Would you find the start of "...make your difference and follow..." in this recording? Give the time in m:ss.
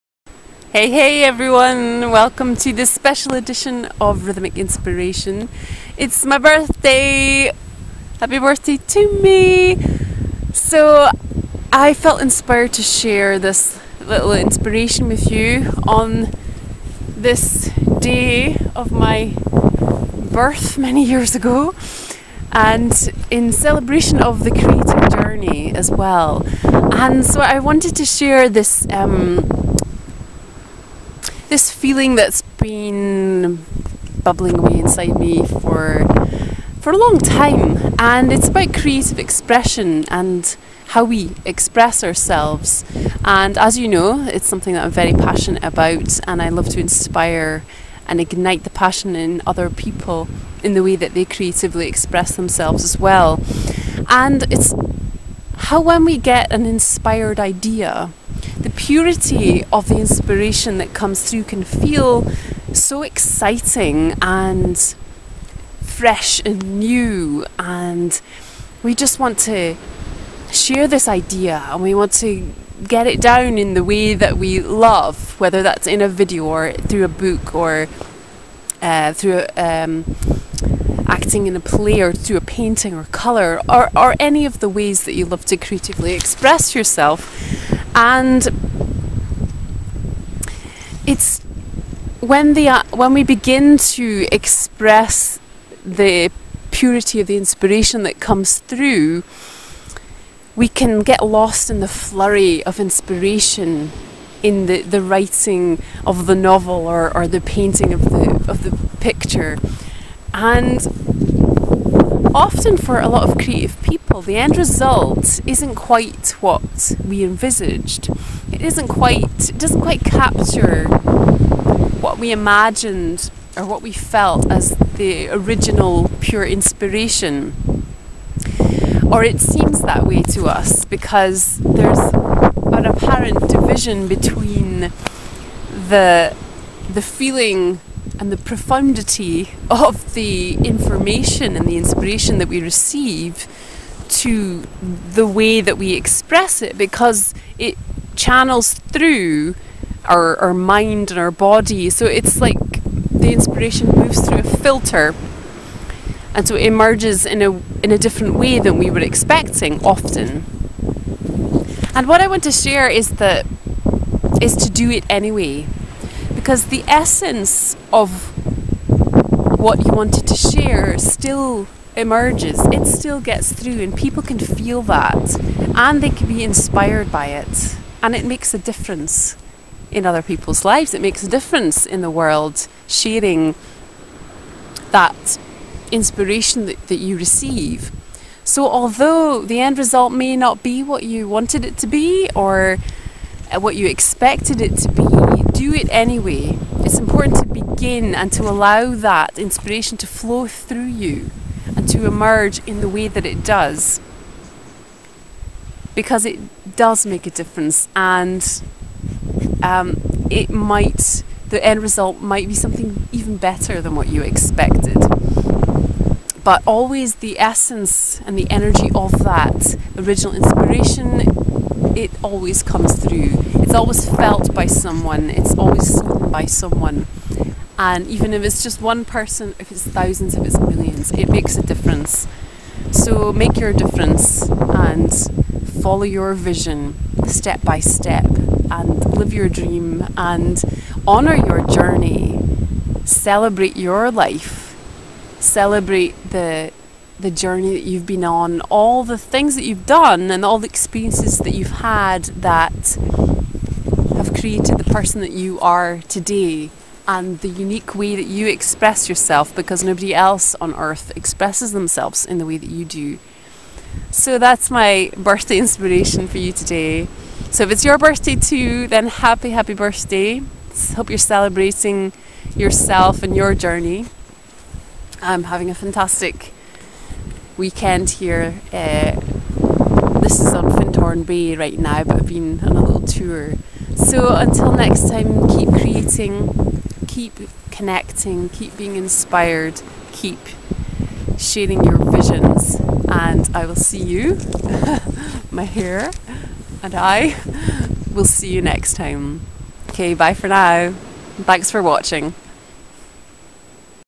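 3:53.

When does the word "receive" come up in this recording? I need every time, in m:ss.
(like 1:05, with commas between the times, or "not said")
2:22, 3:07.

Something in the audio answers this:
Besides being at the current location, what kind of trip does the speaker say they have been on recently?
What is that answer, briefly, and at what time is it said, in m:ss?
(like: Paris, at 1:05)
A little tour, at 4:42.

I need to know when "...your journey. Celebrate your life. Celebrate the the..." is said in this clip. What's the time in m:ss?
4:01.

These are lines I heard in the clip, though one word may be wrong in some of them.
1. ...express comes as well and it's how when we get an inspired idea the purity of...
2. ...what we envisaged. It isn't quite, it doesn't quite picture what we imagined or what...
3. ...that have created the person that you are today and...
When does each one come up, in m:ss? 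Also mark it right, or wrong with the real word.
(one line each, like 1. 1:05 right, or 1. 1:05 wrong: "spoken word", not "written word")
1. 0:51 wrong: "themselves", not "comes"
2. 1:56 wrong: "capture", not "picture"
3. 4:12 right.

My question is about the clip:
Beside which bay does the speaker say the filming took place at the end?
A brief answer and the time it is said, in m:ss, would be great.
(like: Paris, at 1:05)
Findhorn Bay, at 4:40.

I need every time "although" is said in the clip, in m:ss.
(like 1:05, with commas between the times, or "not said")
3:08.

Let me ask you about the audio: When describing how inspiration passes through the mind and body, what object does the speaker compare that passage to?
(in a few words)
A filter.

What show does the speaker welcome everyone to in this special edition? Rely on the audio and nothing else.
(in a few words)
Rhythmic Inspiration.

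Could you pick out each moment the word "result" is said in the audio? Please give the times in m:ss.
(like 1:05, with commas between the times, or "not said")
1:54, 3:09, 3:31.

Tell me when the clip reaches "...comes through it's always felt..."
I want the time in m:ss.
3:42.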